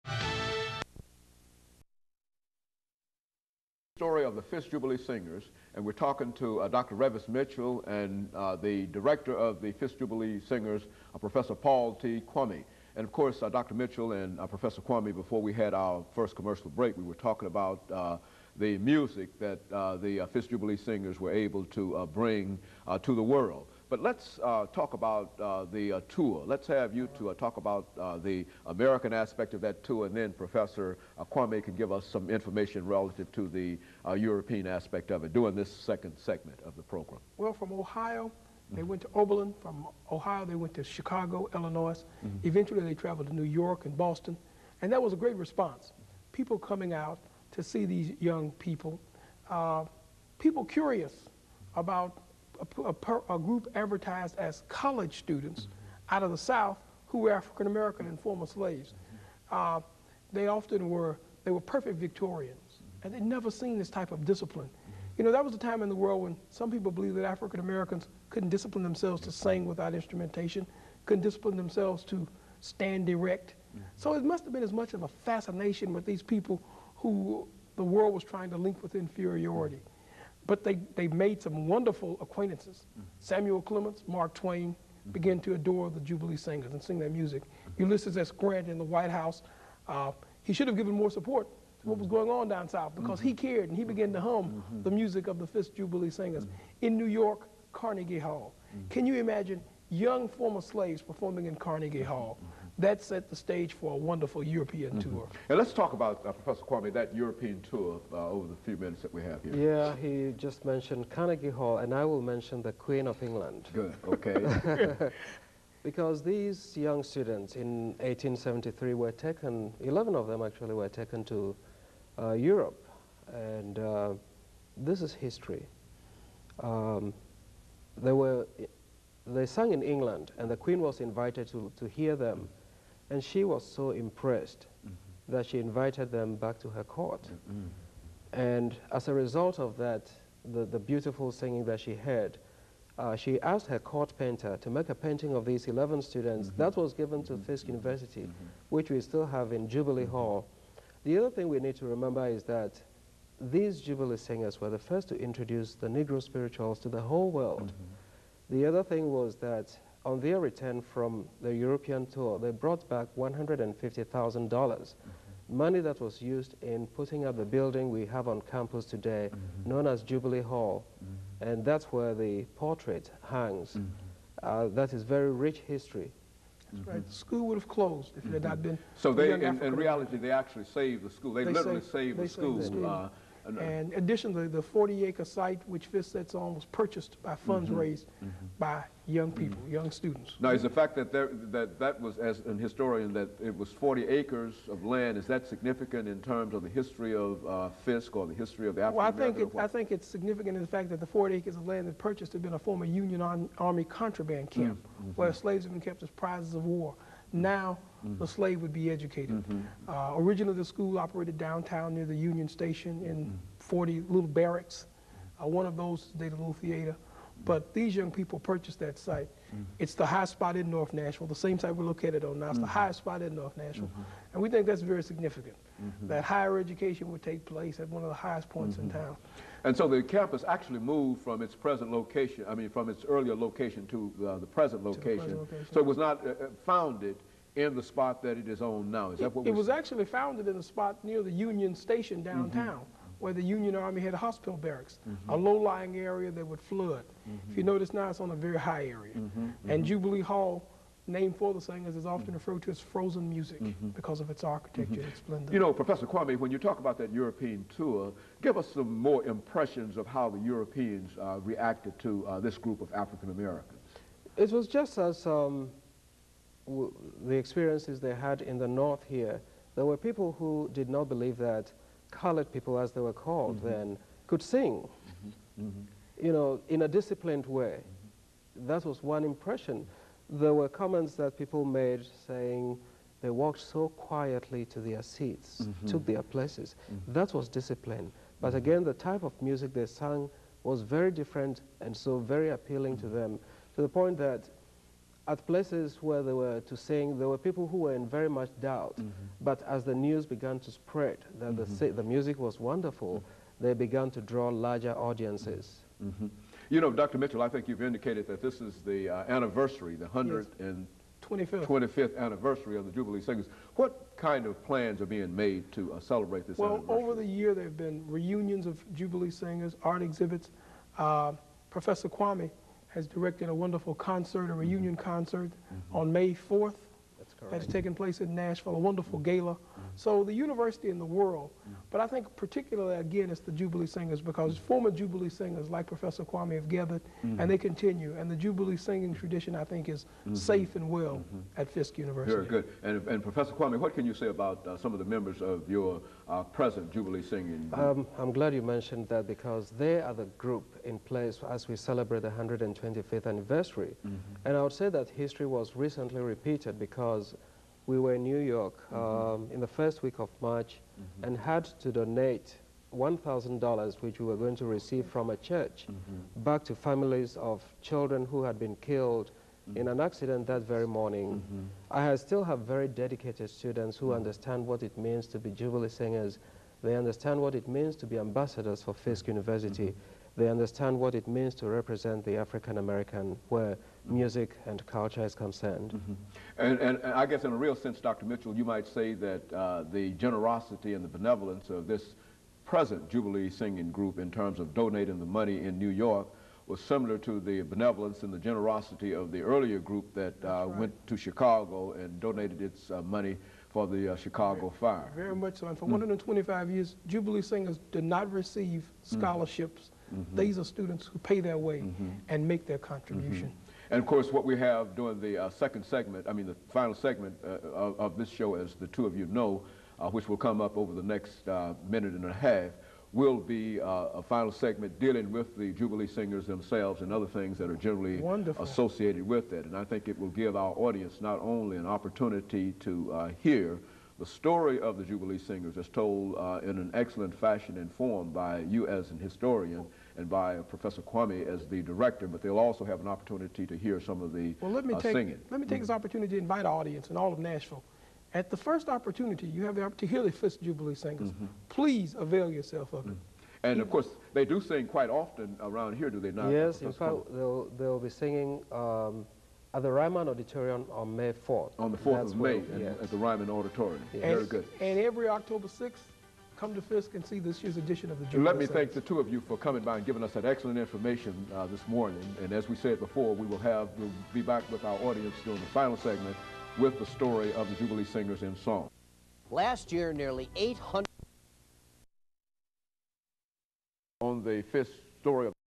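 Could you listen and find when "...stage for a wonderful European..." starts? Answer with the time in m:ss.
1:43.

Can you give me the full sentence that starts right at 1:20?
But they, they made some wonderful acquaintances.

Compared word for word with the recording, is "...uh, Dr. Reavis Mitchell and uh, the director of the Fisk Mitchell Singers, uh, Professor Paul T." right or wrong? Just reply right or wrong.
wrong.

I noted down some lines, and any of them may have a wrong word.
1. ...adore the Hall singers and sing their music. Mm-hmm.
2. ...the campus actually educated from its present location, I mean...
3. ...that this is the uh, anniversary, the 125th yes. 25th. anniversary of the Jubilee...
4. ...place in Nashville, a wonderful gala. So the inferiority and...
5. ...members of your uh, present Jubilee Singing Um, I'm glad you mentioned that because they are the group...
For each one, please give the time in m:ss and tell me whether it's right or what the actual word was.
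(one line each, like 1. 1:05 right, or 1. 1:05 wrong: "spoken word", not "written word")
1. 1:25 wrong: "Jubilee", not "Hall"
2. 3:49 wrong: "moved", not "educated"
3. 5:08 right
4. 5:27 wrong: "university", not "inferiority"
5. 5:45 right.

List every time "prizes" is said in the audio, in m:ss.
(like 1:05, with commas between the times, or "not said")
3:26.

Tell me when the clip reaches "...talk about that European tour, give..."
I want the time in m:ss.
4:16.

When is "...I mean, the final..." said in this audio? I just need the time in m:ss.
6:56.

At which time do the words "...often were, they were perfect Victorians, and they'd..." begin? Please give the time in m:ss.
1:00.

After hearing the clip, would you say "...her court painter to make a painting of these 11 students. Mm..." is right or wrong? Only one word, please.
right.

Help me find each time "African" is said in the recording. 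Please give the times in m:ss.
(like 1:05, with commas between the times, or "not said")
0:57, 1:07, 3:18, 4:22, 6:22.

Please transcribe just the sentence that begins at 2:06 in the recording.
Um, they were they sang in England, and the Queen was invited to, to hear them.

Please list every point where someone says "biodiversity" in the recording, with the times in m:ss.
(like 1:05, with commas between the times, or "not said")
not said.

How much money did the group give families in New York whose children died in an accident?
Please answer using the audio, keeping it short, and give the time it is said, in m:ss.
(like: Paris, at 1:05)
$1,000, at 6:03.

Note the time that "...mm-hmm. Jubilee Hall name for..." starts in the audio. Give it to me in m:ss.
4:09.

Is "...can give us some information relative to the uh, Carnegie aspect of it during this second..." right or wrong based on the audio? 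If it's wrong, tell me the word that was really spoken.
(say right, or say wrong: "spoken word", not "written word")
wrong: "European", not "Carnegie".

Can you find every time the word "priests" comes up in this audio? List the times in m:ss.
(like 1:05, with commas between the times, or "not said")
not said.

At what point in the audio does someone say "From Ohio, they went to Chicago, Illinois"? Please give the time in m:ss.
0:39.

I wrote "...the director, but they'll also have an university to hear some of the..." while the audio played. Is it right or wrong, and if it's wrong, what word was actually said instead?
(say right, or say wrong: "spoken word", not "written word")
wrong: "opportunity", not "university".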